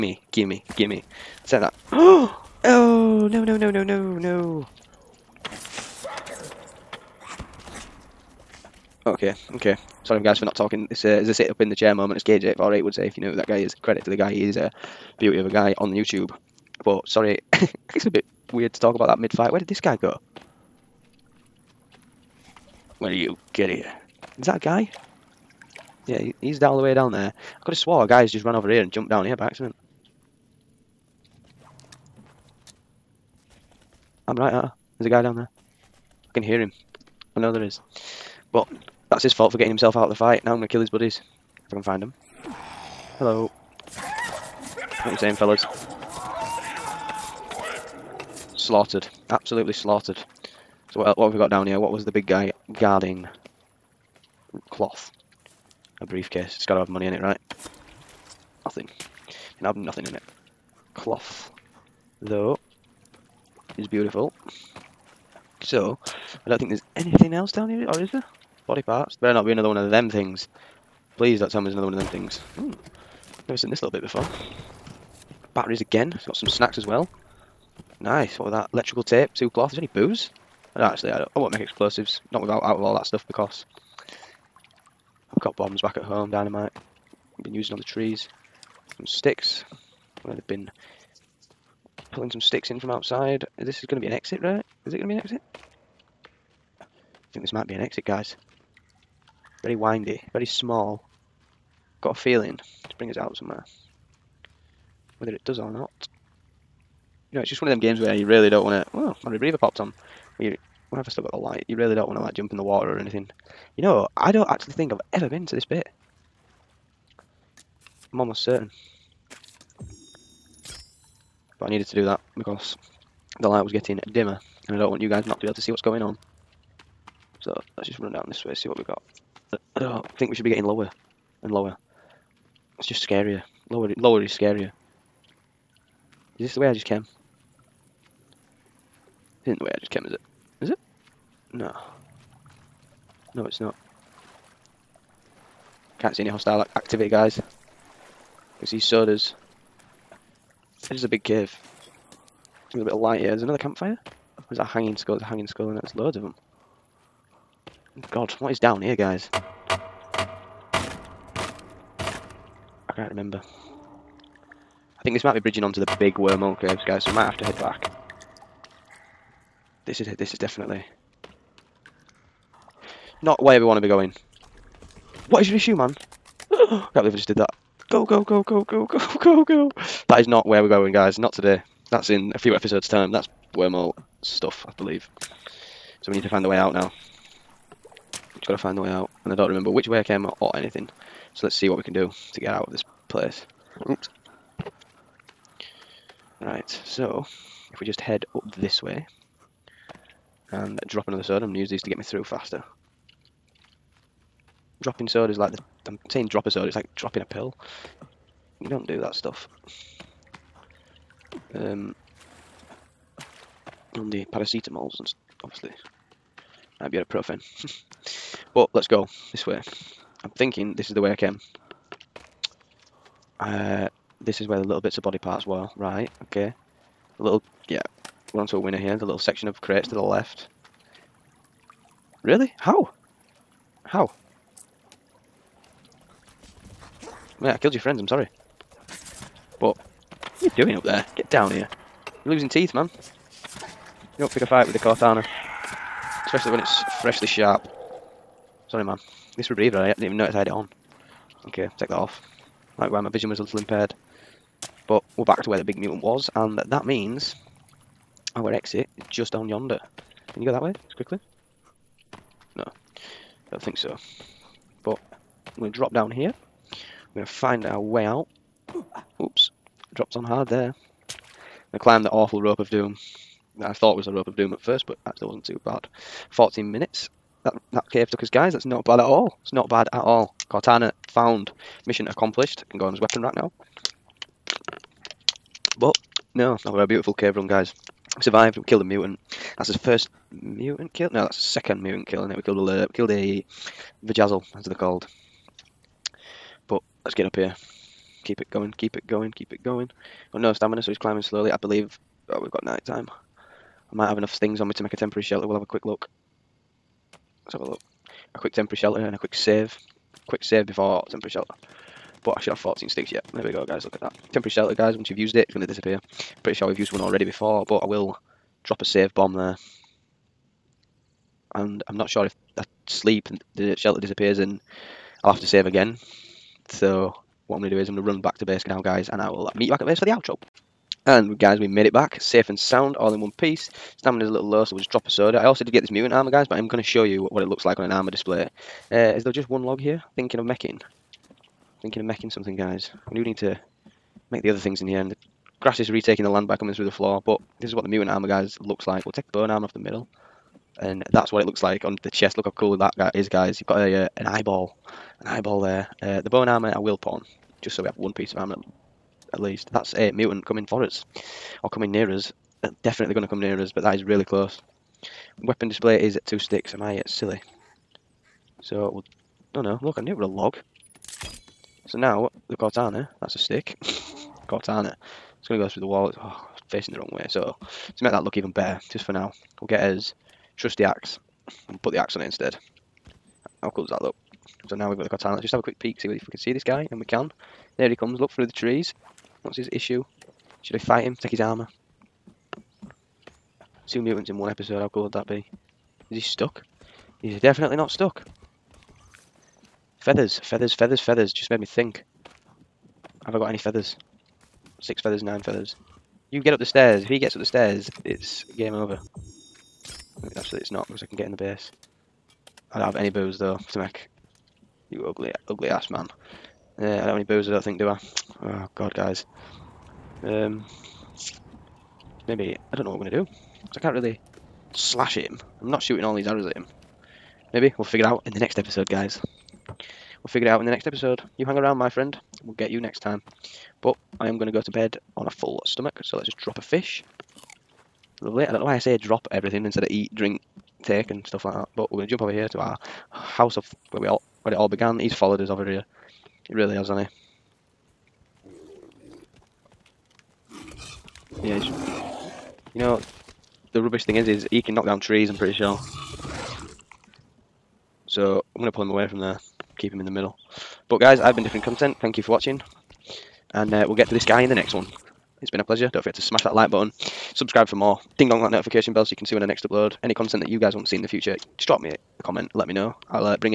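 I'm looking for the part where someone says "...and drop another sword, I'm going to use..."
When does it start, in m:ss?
3:20.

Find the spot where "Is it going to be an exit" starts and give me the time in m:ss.
1:34.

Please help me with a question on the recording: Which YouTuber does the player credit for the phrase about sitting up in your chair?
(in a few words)
KJ48.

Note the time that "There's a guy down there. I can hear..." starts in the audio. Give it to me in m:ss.
0:34.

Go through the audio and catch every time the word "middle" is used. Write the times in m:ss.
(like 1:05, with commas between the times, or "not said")
5:49, 7:40.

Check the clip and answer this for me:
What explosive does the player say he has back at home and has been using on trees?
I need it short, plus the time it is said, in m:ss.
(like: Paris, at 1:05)
Dynamite, at 1:26.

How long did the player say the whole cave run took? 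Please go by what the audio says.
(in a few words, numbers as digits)
14 minutes.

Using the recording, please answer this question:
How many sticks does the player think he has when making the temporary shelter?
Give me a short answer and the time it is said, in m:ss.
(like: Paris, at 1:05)
14, at 5:12.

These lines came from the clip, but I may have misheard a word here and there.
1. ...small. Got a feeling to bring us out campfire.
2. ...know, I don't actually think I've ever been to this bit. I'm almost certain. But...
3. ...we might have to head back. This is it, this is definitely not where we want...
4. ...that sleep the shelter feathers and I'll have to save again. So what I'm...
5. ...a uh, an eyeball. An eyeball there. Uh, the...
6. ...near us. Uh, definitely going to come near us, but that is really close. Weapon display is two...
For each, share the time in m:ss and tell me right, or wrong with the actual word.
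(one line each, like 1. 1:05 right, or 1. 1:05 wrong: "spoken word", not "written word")
1. 1:40 wrong: "somewhere", not "campfire"
2. 1:53 right
3. 2:47 right
4. 5:22 wrong: "disappears", not "feathers"
5. 5:53 right
6. 6:01 right.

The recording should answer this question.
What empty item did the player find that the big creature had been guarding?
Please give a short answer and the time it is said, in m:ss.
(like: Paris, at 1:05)
Briefcase, at 0:56.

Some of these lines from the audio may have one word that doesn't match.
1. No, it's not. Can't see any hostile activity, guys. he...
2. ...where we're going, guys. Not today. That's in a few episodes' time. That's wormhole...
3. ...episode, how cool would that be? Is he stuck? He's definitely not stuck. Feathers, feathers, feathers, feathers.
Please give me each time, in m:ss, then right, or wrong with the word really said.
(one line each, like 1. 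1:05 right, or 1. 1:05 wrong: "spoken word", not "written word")
1. 2:23 right
2. 3:00 right
3. 6:34 right.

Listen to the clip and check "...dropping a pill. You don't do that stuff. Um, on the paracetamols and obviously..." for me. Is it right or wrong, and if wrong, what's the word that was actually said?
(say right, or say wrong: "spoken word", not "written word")
right.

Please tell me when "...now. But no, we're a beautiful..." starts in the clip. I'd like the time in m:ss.
4:43.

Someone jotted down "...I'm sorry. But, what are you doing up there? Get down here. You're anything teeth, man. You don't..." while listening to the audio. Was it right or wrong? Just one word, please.
wrong.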